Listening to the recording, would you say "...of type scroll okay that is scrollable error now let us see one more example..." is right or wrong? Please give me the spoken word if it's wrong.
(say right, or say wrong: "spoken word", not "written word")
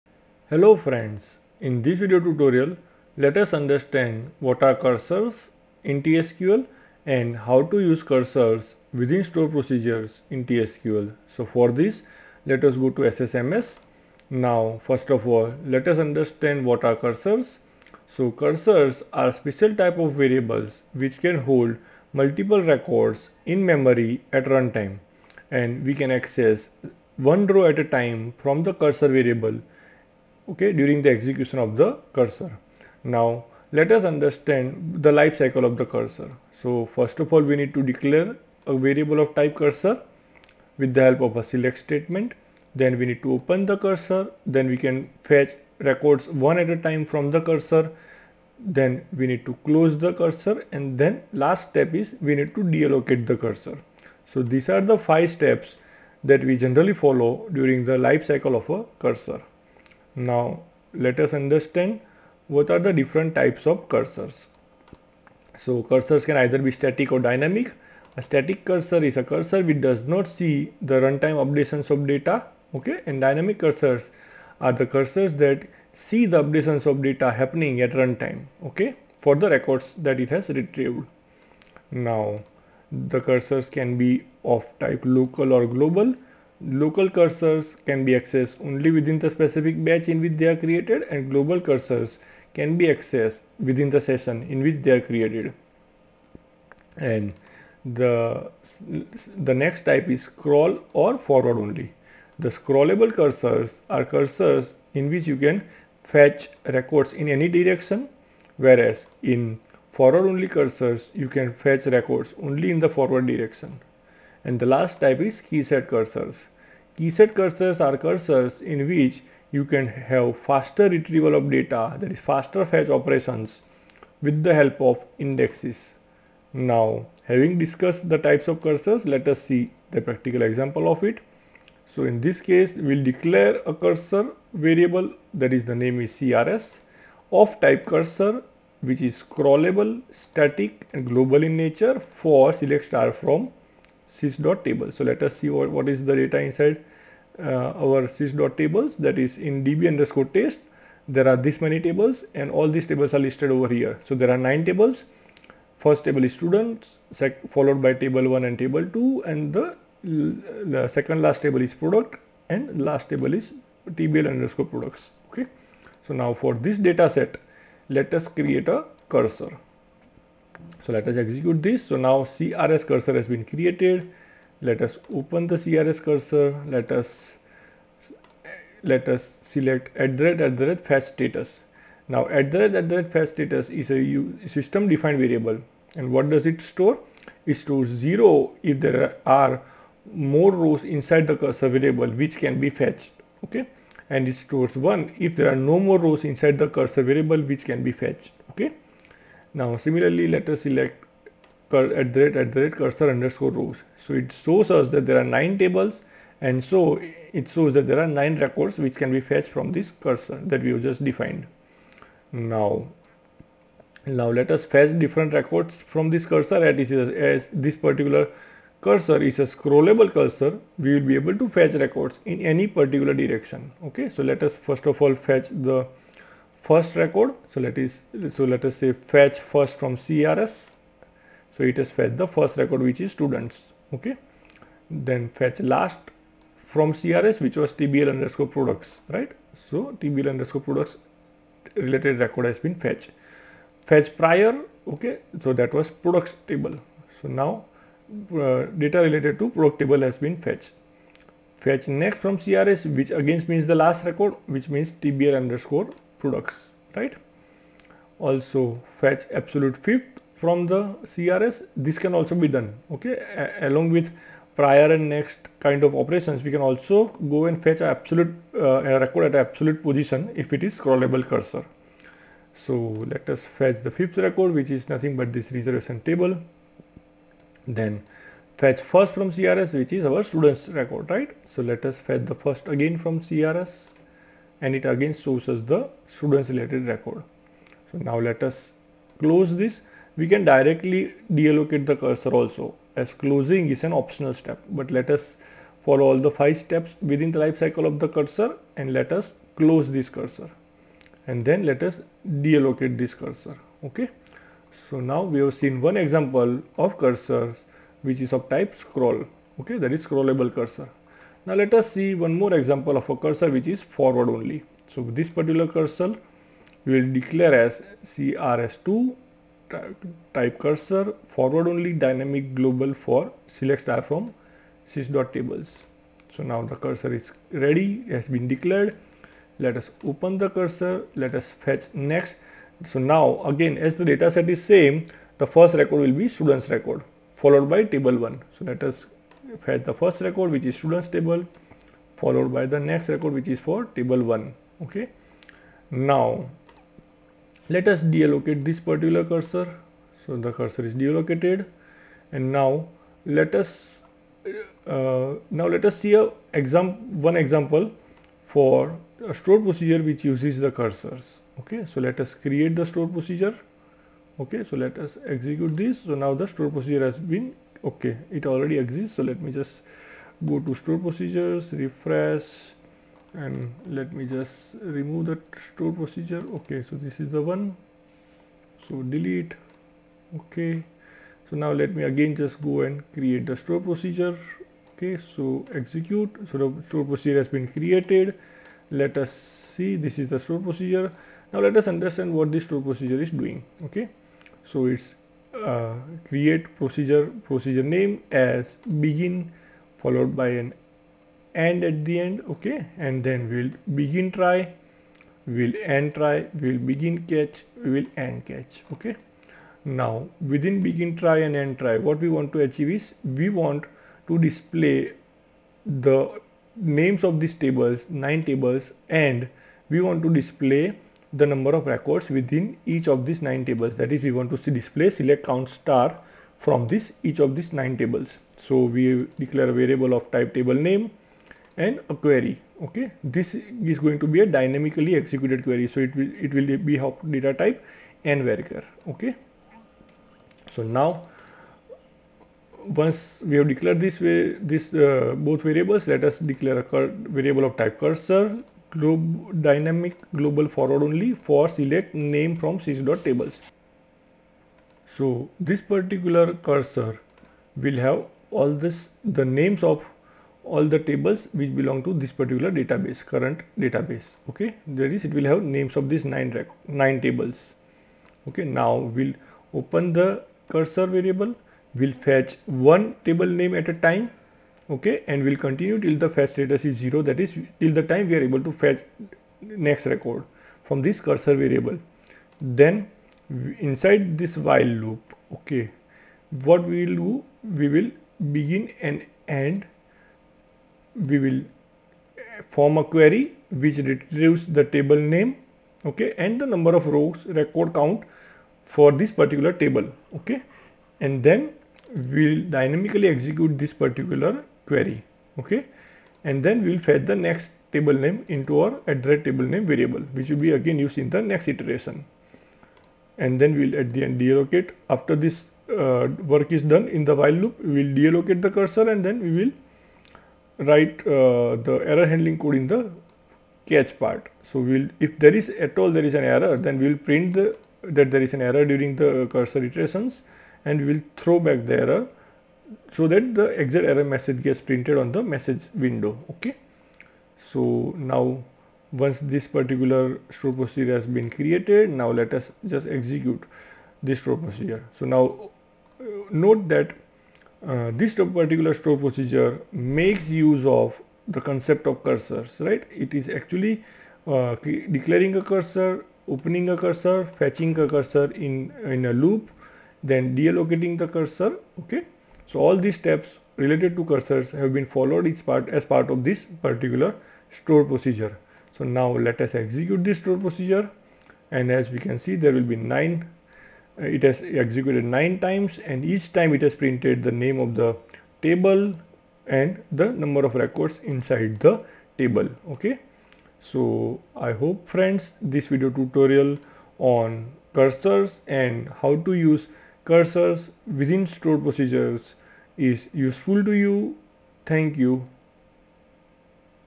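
wrong: "cursor", not "error".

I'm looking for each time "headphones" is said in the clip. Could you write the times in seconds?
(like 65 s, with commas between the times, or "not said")
not said.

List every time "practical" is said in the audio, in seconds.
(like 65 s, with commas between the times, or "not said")
129 s.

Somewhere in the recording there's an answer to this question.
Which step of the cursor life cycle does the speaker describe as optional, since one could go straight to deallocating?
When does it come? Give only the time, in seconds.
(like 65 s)
293 s.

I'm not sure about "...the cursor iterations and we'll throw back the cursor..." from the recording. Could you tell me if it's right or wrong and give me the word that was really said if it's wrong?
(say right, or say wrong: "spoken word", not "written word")
wrong: "error", not "cursor".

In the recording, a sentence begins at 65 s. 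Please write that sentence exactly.
So cursors can either be static or dynamic.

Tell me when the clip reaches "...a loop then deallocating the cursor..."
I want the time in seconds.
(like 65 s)
559 s.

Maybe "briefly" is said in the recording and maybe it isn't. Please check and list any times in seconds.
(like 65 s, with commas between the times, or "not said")
not said.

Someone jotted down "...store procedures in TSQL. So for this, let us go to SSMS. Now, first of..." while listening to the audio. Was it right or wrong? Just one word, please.
right.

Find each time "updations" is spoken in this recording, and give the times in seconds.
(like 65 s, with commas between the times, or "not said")
71 s, 76 s.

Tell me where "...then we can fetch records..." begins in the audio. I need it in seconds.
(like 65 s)
44 s.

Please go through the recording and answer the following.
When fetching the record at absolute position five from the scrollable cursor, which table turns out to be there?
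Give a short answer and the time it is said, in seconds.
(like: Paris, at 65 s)
reservation, at 275 s.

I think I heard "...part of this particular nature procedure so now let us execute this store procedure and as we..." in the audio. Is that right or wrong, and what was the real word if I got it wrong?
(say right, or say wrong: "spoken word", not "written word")
wrong: "store", not "nature".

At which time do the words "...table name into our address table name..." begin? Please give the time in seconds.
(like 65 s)
507 s.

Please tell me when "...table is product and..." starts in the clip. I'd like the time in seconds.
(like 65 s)
161 s.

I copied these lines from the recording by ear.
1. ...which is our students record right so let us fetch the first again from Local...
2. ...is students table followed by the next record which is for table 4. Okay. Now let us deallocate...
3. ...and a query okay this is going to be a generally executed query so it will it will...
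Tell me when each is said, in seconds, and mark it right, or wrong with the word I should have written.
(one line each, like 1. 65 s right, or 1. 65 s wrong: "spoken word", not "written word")
1. 279 s wrong: "CRS", not "Local"
2. 340 s wrong: "1", not "4"
3. 431 s wrong: "dynamically", not "generally".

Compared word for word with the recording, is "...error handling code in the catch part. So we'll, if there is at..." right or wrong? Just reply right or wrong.
right.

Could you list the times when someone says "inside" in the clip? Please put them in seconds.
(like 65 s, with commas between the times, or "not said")
146 s, 190 s, 196 s, 483 s, 581 s.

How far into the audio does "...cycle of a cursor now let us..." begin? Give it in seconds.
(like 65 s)
58 s.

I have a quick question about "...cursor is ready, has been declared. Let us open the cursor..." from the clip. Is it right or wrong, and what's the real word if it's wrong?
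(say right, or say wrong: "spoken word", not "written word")
right.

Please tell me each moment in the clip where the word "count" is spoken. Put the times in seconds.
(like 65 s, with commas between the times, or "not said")
425 s, 497 s.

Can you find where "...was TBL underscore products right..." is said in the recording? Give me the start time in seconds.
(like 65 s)
237 s.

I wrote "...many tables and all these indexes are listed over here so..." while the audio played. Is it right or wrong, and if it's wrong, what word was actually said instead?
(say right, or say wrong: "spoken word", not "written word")
wrong: "tables", not "indexes".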